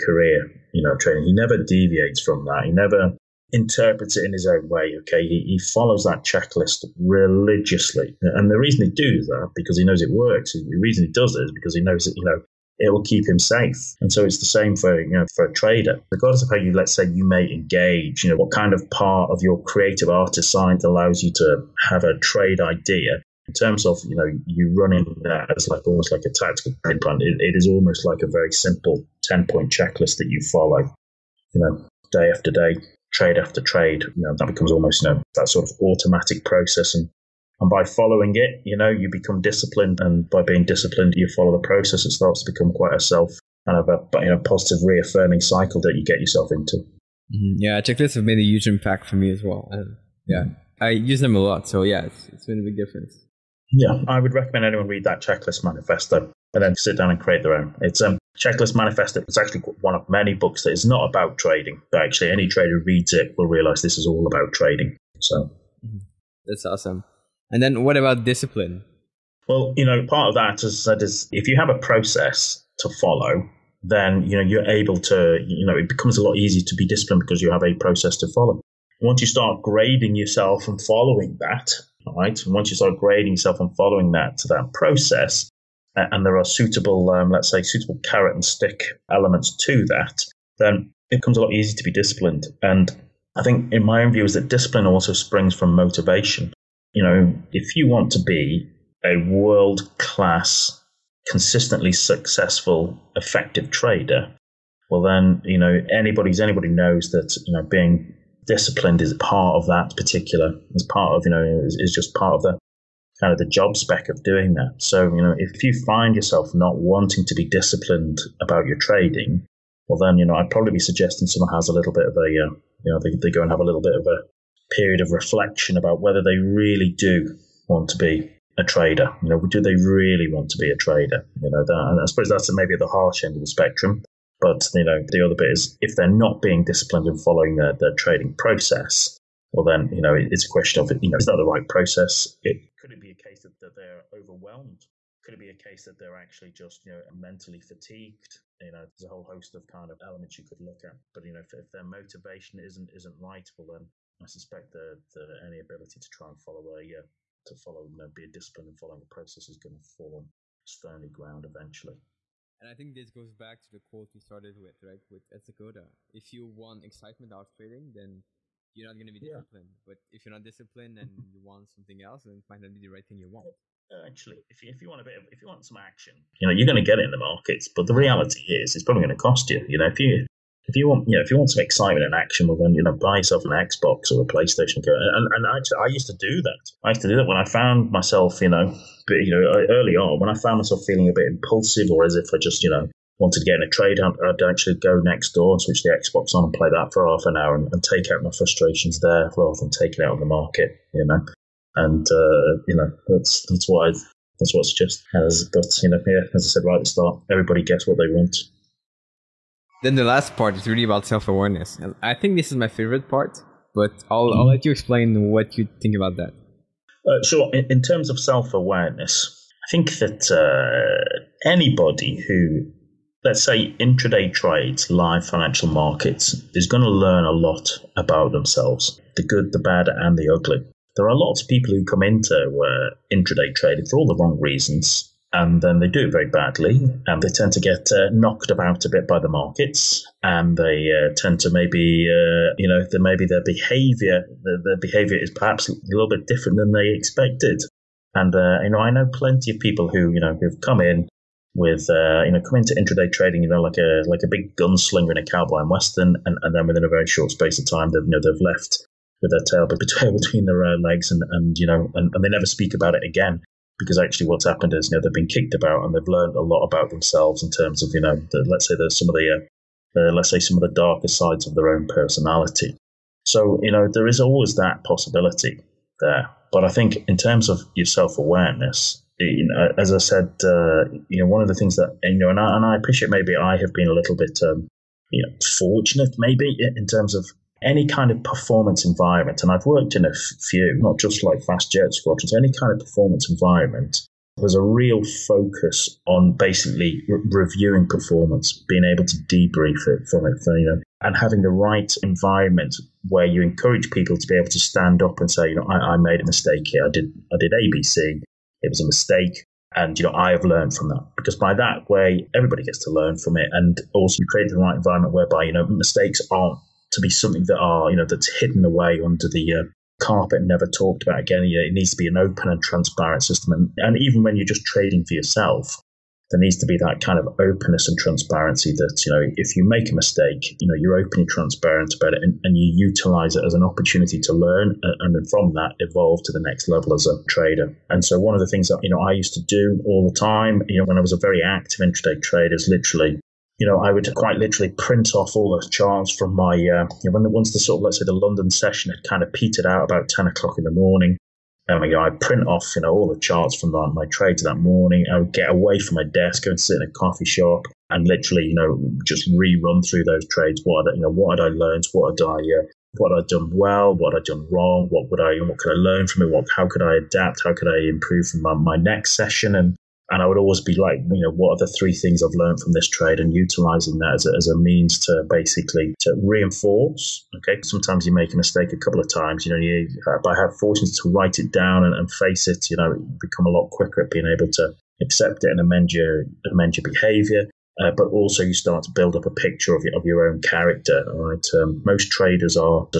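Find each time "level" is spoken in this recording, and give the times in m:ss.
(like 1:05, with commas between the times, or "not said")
5:36.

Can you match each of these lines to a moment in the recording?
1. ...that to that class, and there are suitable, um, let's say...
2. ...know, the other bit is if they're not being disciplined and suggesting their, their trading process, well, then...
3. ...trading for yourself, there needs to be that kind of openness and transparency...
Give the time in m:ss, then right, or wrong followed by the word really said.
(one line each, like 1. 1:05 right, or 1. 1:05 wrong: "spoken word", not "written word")
1. 1:24 wrong: "process", not "class"
2. 2:14 wrong: "following", not "suggesting"
3. 5:24 right.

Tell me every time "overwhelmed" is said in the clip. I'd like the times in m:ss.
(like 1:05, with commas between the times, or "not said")
2:24.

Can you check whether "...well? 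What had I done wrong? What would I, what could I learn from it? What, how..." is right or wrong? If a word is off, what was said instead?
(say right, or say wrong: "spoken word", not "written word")
right.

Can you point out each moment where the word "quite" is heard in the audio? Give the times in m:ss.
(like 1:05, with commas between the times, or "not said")
0:42, 5:44.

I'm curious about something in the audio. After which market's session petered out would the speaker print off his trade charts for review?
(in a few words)
London.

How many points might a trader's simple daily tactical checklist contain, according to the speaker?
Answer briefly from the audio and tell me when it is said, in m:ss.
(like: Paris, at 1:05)
10, at 0:29.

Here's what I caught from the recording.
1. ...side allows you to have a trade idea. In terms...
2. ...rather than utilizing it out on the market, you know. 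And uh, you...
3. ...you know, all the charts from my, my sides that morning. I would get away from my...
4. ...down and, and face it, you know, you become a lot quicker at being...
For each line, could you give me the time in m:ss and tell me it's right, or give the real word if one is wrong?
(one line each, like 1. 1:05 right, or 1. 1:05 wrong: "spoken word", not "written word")
1. 0:20 right
2. 3:19 wrong: "taking", not "utilizing"
3. 5:52 wrong: "trades", not "sides"
4. 6:21 right.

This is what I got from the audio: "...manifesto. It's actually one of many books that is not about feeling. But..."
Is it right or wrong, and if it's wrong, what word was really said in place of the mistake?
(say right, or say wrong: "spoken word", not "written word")
wrong: "trading", not "feeling".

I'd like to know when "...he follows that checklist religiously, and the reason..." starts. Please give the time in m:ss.
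0:05.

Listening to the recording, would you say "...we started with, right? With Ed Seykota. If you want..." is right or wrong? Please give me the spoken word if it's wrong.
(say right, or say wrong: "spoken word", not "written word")
right.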